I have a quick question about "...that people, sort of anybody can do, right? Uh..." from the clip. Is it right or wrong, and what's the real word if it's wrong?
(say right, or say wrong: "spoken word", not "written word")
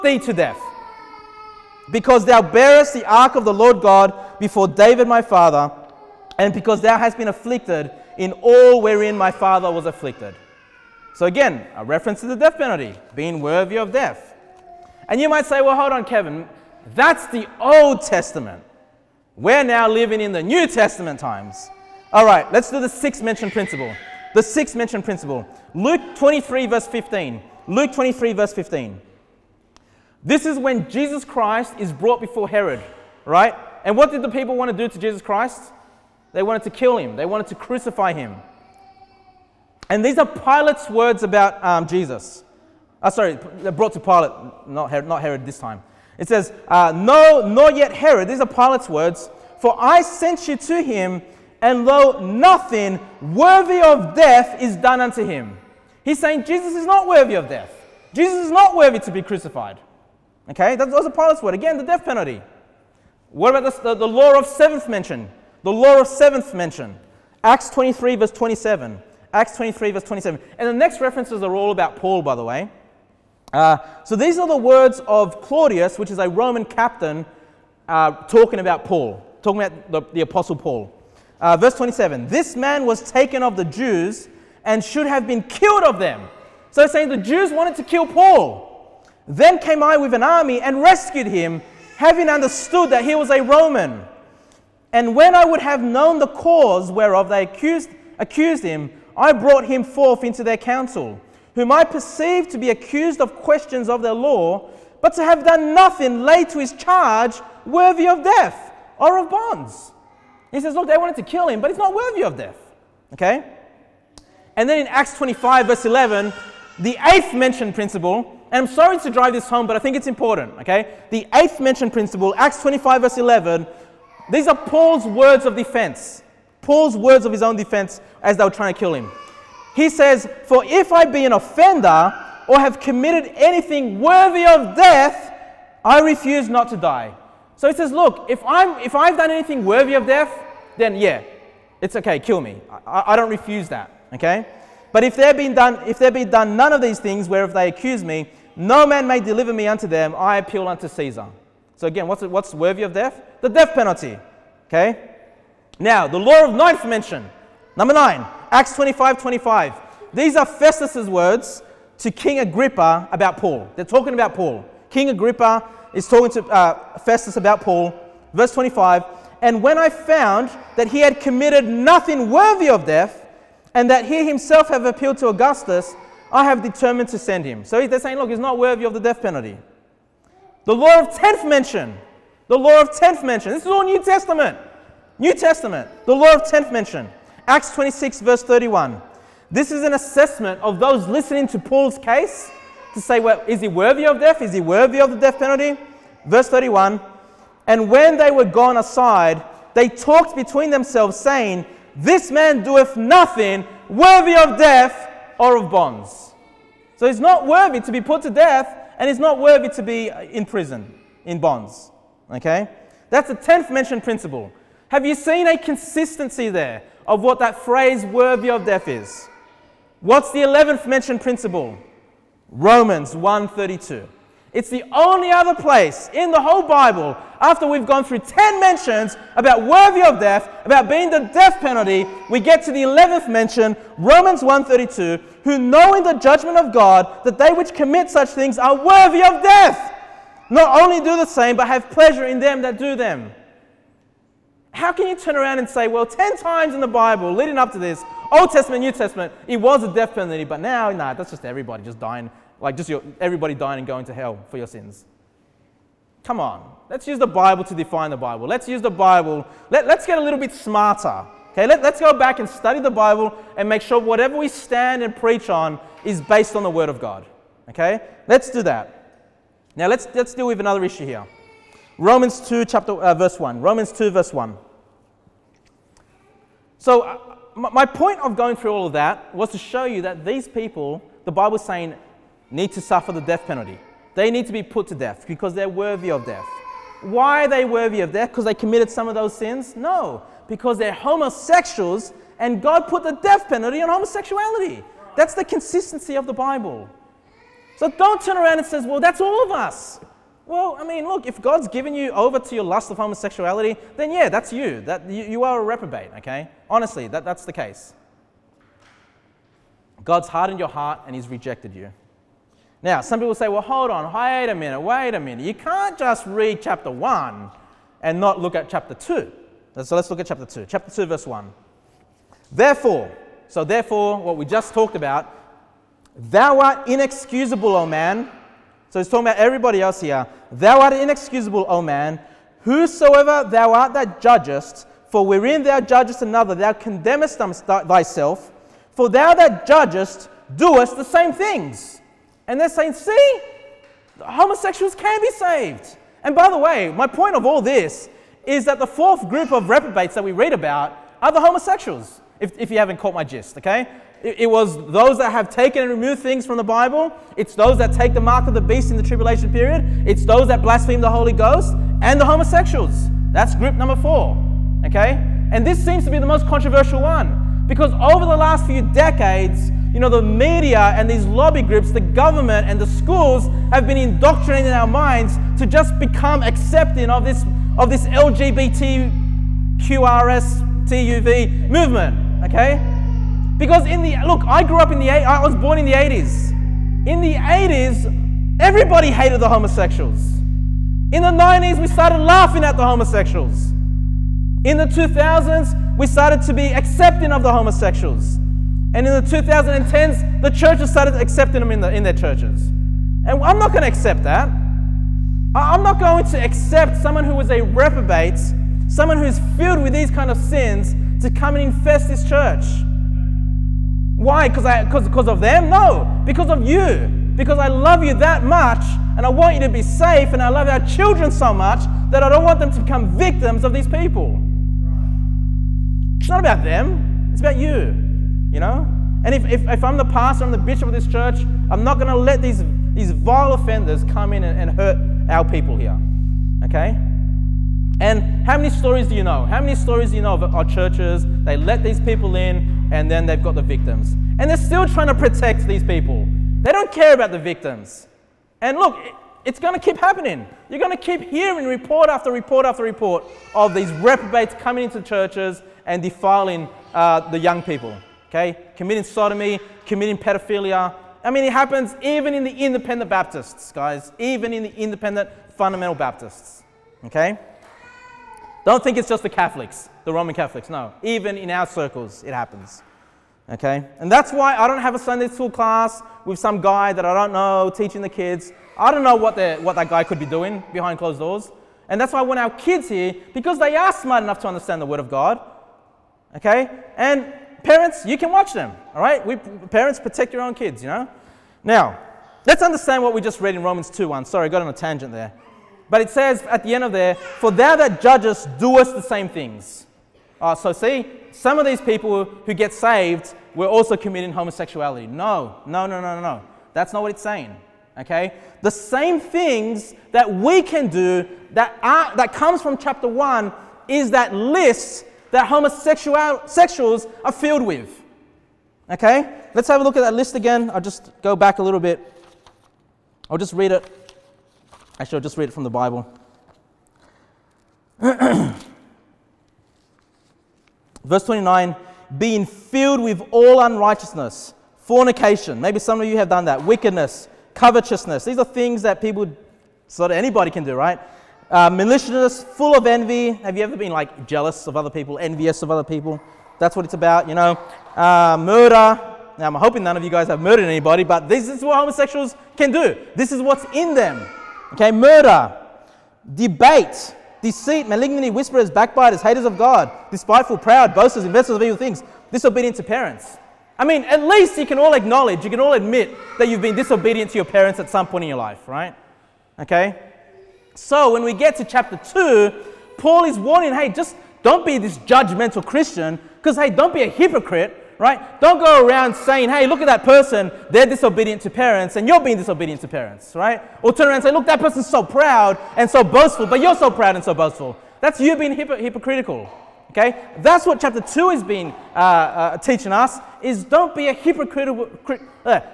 right.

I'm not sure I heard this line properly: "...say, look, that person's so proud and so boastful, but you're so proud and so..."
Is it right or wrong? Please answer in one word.
right.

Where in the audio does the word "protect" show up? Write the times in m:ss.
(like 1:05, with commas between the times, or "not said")
7:25, 8:09.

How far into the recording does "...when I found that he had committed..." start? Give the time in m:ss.
2:49.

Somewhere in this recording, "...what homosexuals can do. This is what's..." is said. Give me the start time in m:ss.
9:11.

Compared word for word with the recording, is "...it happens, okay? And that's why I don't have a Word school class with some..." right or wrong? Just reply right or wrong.
wrong.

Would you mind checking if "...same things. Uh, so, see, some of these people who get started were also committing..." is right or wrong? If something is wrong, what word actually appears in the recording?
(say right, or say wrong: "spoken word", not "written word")
wrong: "saved", not "started".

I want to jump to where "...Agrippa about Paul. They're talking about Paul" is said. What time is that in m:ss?
2:42.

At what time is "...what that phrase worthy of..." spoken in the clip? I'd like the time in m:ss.
3:37.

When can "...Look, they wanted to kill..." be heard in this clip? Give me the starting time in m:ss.
1:50.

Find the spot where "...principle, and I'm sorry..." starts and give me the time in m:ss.
1:57.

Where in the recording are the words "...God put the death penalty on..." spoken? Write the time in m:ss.
4:52.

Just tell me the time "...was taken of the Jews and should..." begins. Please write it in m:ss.
1:22.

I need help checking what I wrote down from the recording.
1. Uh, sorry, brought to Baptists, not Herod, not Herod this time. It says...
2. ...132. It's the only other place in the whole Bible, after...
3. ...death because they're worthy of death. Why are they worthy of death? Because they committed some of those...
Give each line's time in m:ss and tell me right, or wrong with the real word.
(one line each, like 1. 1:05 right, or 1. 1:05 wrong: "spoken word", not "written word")
1. 0:43 wrong: "Pilate", not "Baptists"
2. 3:43 right
3. 4:44 right.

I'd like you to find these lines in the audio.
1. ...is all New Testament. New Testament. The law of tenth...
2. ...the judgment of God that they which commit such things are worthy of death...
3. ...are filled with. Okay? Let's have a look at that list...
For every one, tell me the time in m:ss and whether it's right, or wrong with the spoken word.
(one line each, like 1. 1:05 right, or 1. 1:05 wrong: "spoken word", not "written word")
1. 3:03 right
2. 3:56 right
3. 8:37 right.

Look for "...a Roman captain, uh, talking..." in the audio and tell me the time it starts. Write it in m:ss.
1:16.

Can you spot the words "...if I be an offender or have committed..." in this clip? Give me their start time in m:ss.
2:10.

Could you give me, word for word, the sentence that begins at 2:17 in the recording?
So he says, Look, if, I'm, if I've done anything worthy of death, then yeah, it's okay, kill me.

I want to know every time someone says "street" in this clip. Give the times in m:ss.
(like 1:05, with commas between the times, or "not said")
not said.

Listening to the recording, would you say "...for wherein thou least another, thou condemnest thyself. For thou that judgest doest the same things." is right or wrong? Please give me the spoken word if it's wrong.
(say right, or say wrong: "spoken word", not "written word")
wrong: "judgest", not "least".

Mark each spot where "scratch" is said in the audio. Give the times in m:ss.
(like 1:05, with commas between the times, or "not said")
not said.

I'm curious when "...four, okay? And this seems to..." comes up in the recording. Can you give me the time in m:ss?
6:03.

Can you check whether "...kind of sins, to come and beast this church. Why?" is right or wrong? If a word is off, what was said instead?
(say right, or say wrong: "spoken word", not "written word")
wrong: "infest", not "beast".